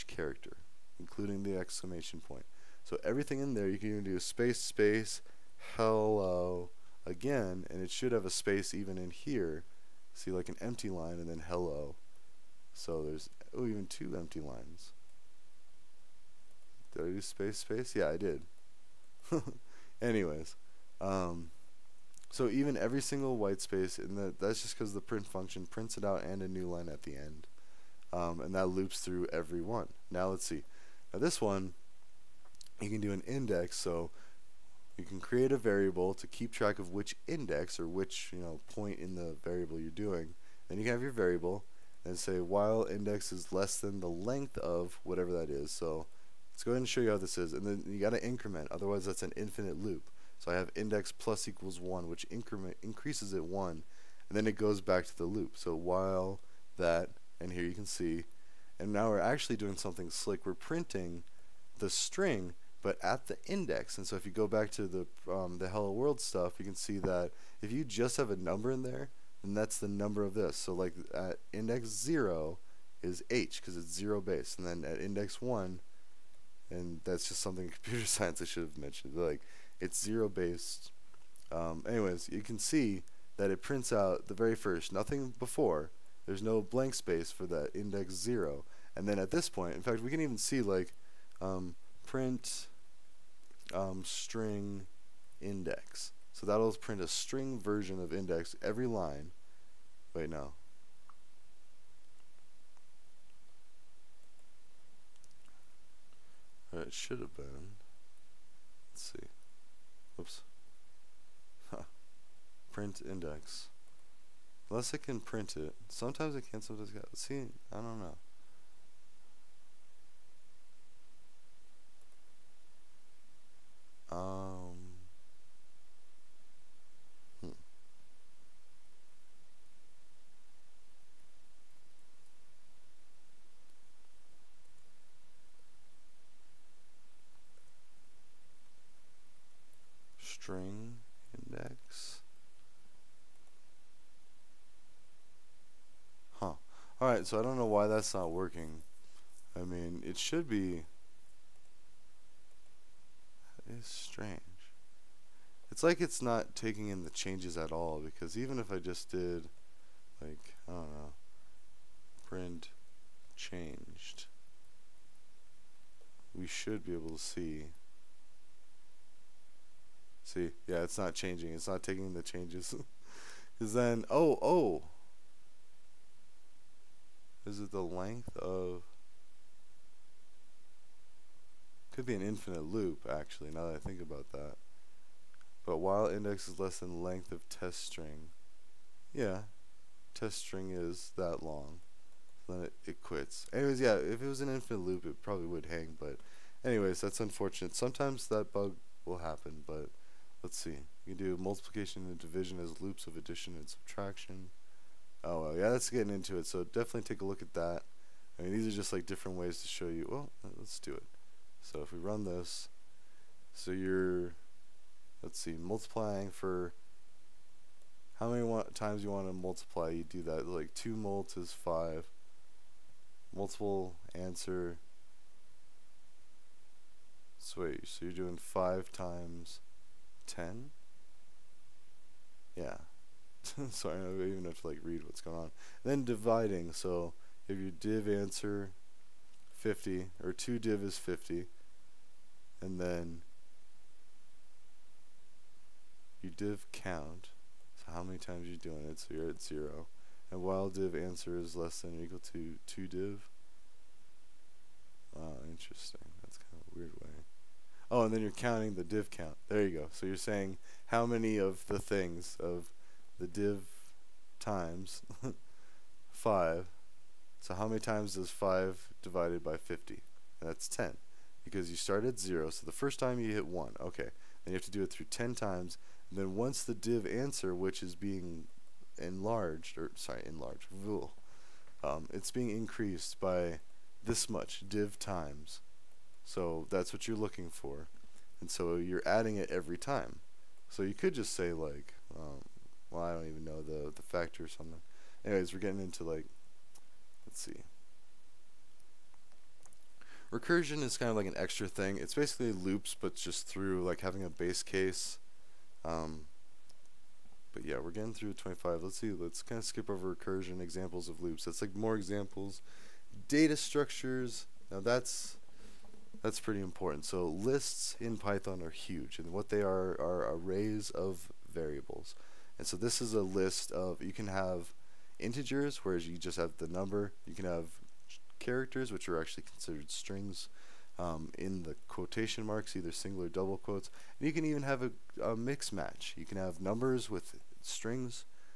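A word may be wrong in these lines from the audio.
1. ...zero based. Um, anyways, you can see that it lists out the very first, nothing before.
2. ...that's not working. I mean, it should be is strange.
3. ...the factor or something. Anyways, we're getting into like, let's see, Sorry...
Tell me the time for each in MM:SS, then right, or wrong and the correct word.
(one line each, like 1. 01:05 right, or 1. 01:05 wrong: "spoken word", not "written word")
1. 01:19 wrong: "prints", not "lists"
2. 02:27 right
3. 04:53 wrong: "Recursion", not "Sorry".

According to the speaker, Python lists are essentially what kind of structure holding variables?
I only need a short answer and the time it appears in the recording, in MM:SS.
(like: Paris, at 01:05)
arrays, at 05:20.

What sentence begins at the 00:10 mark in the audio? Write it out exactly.
See, like an empty line and then hello.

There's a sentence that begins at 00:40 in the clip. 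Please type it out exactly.
Then you can have your variable and say while index is less than the length of whatever that is.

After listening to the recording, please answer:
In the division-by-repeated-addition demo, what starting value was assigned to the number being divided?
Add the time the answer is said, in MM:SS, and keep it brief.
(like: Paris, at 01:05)
50, at 04:00.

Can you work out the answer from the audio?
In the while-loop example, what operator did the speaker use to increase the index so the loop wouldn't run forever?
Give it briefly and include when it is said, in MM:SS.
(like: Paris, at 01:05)
plus equals 1, at 00:51.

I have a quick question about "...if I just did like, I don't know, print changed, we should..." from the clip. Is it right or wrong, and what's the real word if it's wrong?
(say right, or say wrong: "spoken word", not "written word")
right.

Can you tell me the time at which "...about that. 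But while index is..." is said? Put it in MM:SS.
03:04.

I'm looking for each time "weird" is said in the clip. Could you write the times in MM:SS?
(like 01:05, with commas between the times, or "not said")
04:16.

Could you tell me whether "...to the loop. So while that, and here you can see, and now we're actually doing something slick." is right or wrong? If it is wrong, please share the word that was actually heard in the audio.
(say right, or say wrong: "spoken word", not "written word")
right.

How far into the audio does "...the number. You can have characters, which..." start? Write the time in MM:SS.
05:26.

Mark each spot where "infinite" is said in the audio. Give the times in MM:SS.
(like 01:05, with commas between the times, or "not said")
00:49, 03:02, 03:14.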